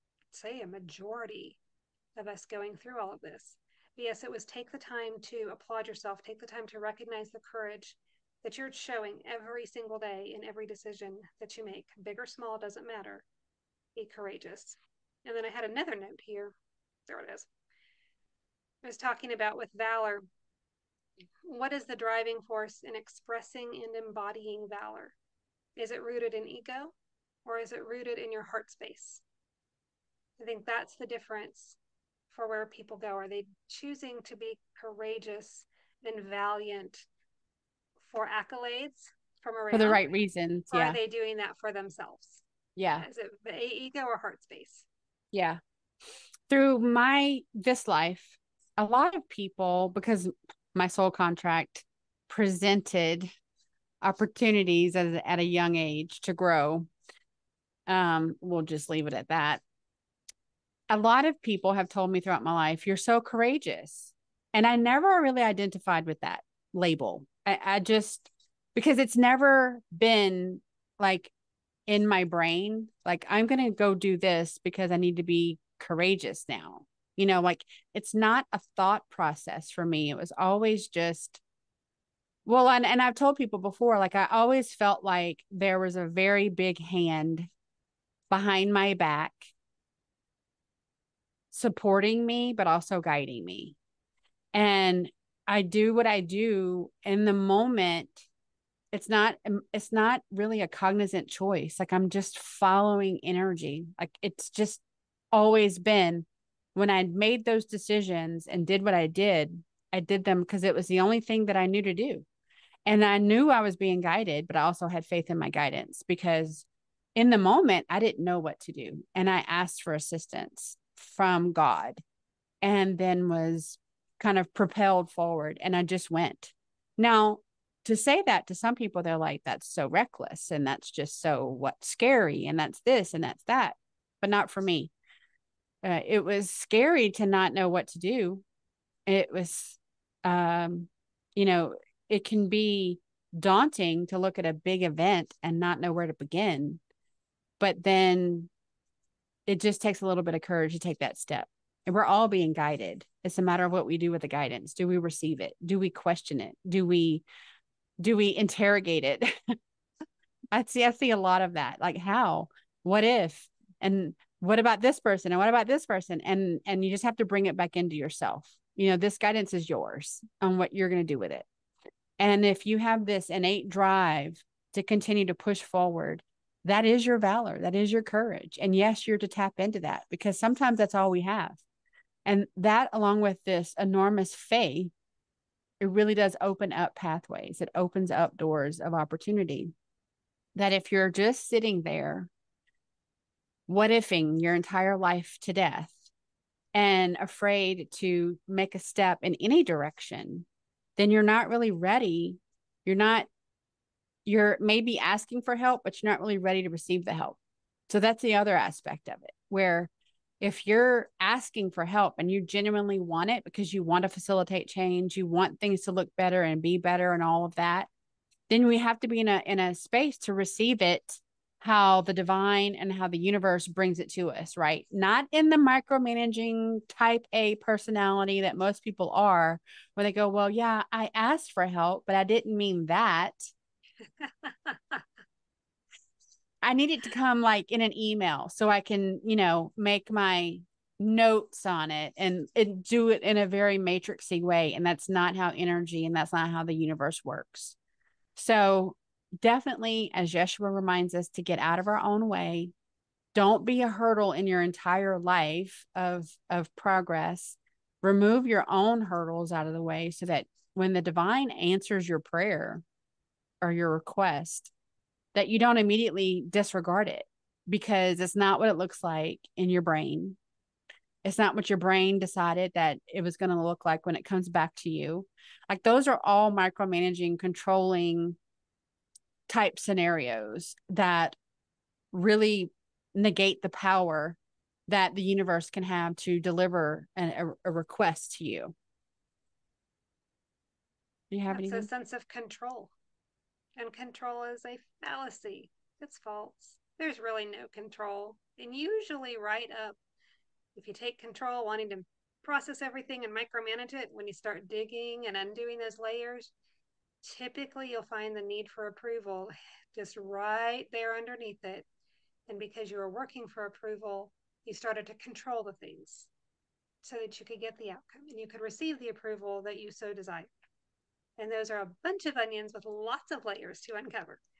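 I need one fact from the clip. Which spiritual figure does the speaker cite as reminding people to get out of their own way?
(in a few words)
Yeshua.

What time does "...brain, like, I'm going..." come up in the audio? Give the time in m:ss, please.
1:12.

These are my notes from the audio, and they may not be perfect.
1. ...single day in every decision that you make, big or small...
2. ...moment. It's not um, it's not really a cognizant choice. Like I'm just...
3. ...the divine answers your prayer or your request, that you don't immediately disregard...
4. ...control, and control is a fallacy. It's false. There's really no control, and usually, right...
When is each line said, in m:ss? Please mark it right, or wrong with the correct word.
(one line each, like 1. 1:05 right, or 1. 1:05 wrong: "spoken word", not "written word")
1. 0:09 right
2. 1:37 right
3. 4:20 right
4. 4:52 right.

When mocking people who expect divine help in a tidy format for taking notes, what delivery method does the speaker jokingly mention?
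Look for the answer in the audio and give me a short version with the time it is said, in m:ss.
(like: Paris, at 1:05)
An email, at 3:57.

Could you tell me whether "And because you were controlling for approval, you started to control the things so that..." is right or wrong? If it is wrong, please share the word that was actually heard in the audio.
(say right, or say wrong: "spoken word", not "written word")
wrong: "working", not "controlling".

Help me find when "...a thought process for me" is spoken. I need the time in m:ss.
1:18.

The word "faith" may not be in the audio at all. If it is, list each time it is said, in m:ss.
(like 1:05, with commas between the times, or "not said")
1:55, 3:04.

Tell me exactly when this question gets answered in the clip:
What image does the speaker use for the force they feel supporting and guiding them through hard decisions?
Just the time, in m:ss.
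1:25.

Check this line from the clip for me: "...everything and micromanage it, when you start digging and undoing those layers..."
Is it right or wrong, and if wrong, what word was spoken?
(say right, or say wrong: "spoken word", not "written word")
right.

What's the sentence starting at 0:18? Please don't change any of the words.
I was talking about with valor.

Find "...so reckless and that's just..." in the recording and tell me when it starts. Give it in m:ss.
2:09.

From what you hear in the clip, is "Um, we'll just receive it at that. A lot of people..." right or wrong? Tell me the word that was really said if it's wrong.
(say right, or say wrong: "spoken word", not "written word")
wrong: "leave", not "receive".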